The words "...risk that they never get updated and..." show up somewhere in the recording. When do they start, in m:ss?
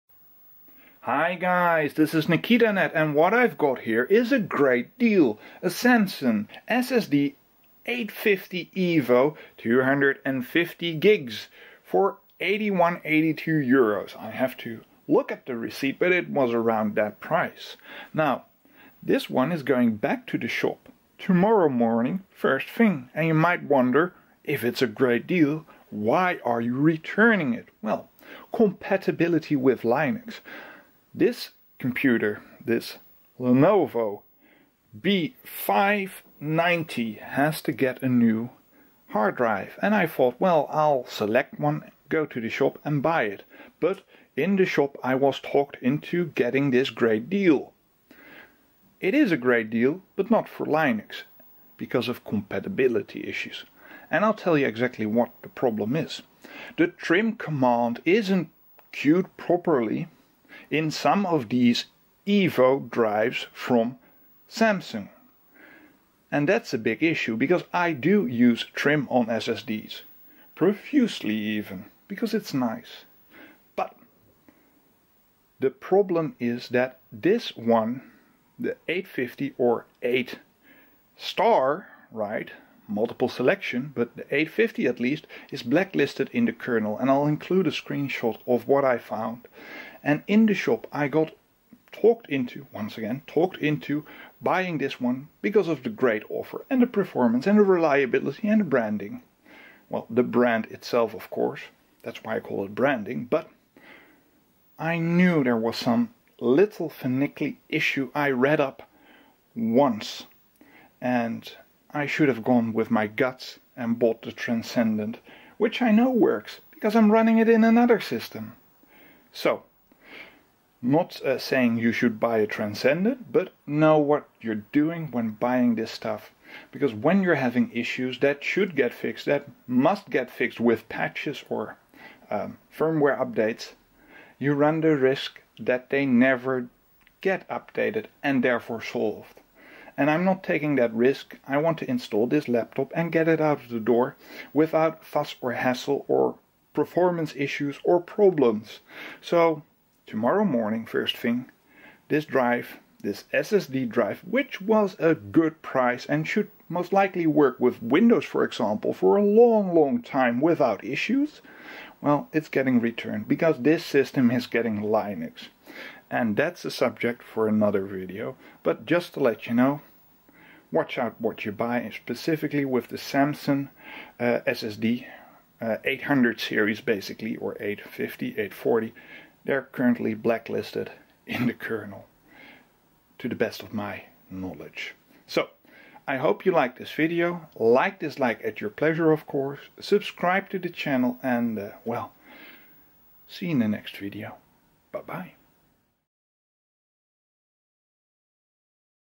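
2:14.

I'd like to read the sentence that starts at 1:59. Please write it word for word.
So, not uh, saying you should buy a transcendent, but know what you're doing when buying this stuff.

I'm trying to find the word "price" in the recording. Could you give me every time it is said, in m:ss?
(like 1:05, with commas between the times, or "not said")
0:17, 2:35.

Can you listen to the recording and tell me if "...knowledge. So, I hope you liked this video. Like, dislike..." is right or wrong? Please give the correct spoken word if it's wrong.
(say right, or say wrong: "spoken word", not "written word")
right.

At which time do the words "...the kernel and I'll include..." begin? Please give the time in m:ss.
1:26.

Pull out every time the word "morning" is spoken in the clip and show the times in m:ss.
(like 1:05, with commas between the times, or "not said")
0:21, 2:30.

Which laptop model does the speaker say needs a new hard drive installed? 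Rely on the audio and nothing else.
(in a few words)
Lenovo B590.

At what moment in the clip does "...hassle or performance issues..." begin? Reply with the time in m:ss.
2:25.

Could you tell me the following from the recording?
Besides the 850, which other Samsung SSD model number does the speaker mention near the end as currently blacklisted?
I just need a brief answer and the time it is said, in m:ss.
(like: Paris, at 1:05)
840, at 2:58.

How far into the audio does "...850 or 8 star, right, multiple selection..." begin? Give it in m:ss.
1:18.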